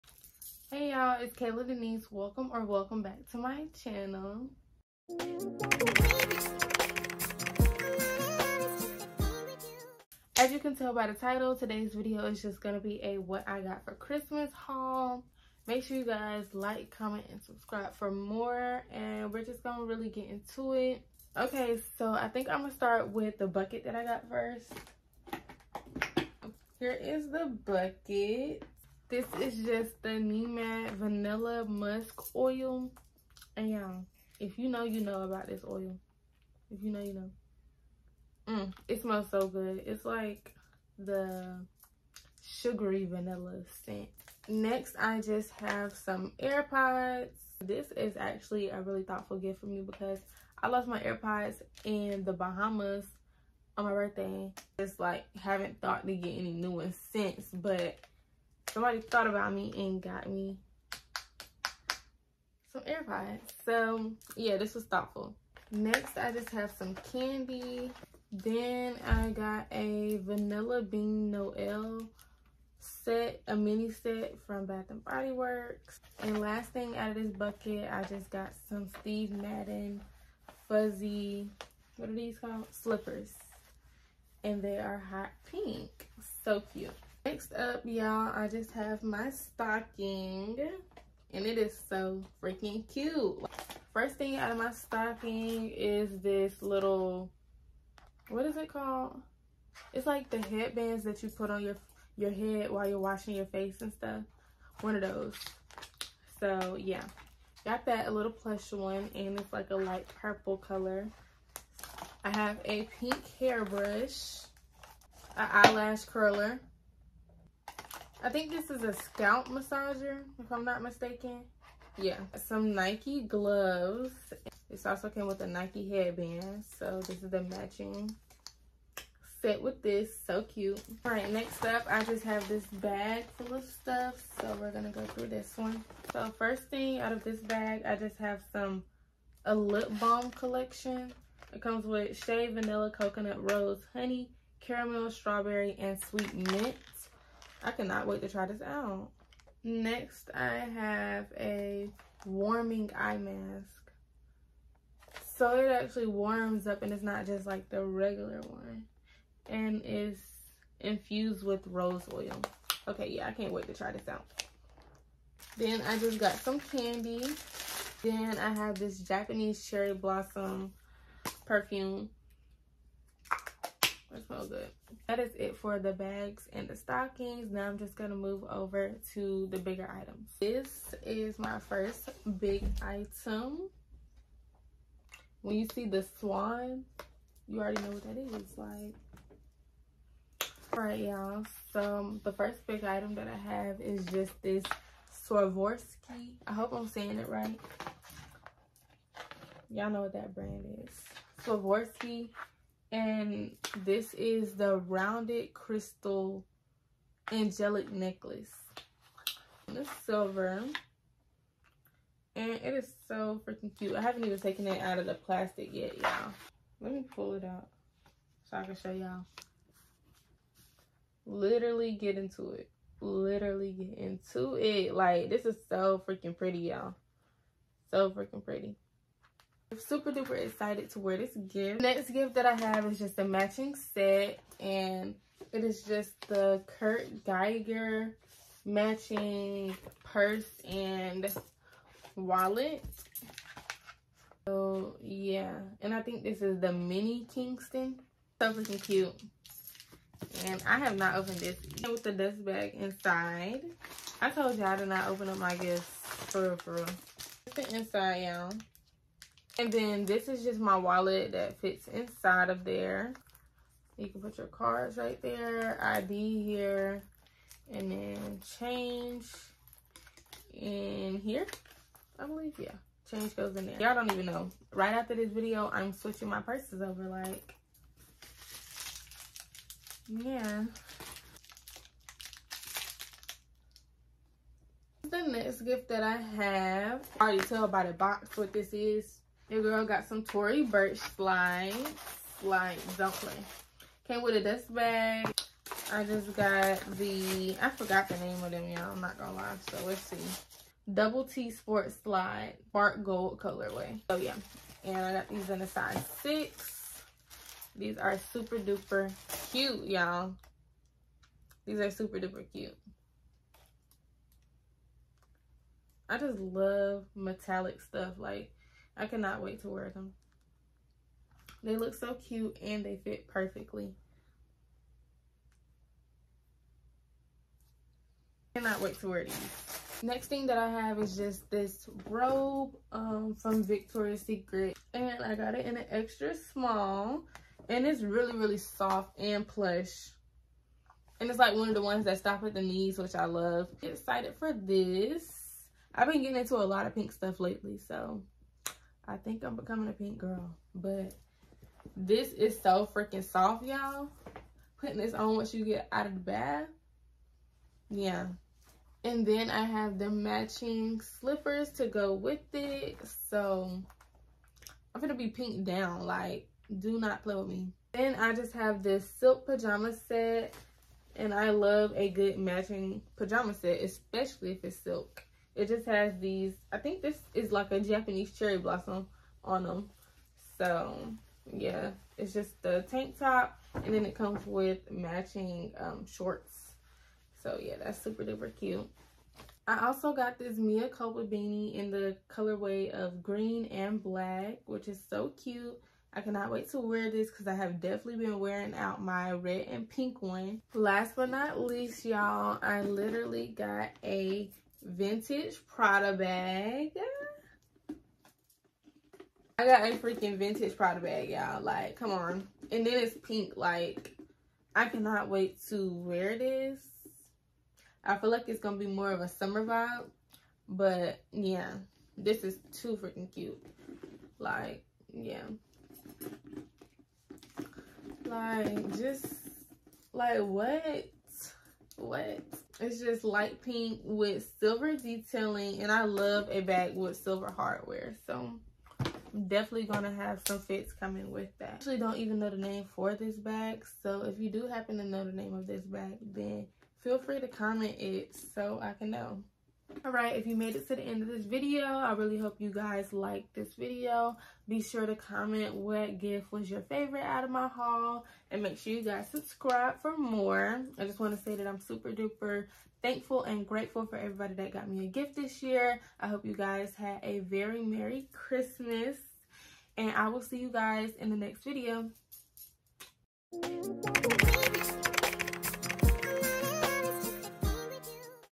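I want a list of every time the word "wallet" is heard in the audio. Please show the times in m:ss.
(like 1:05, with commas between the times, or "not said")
4:02, 4:20.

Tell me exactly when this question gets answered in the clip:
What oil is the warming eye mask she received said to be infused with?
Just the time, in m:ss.
2:41.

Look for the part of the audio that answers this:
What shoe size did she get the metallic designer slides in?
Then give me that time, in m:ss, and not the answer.
5:06.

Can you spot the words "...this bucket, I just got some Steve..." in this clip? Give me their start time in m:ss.
1:17.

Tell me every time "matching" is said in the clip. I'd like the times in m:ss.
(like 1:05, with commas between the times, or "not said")
2:07, 3:53, 3:58, 6:00, 6:12, 6:24.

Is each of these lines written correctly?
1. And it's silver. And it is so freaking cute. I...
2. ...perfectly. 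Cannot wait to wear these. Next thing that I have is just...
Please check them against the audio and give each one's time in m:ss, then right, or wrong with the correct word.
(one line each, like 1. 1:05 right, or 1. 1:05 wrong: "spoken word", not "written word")
1. 3:29 right
2. 5:23 right.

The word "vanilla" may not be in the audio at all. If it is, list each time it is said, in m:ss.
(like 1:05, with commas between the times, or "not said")
0:30, 0:43, 1:10, 2:22.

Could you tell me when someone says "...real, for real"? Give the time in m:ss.
4:16.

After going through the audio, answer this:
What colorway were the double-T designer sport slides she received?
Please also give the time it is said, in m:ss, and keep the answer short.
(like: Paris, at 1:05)
Bark Gold, at 5:02.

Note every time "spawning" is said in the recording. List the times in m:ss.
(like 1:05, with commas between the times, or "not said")
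not said.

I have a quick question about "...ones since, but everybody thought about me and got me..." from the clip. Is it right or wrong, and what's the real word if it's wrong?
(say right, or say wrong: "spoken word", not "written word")
wrong: "somebody", not "everybody".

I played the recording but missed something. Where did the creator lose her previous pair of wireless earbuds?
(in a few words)
The Bahamas.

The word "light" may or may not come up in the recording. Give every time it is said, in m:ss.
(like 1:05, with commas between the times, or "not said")
1:49, 7:13.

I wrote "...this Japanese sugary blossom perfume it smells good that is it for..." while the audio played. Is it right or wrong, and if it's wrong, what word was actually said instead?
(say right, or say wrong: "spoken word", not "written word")
wrong: "cherry", not "sugary".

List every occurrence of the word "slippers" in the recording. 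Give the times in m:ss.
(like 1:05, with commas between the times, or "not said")
1:22, 6:01.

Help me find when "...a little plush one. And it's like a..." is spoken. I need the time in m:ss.
1:48.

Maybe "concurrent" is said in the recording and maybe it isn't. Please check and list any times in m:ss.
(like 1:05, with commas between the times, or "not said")
not said.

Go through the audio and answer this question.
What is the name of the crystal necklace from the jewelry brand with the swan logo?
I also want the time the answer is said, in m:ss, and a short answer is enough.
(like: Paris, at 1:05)
Rounded crystal angelic necklace, at 3:24.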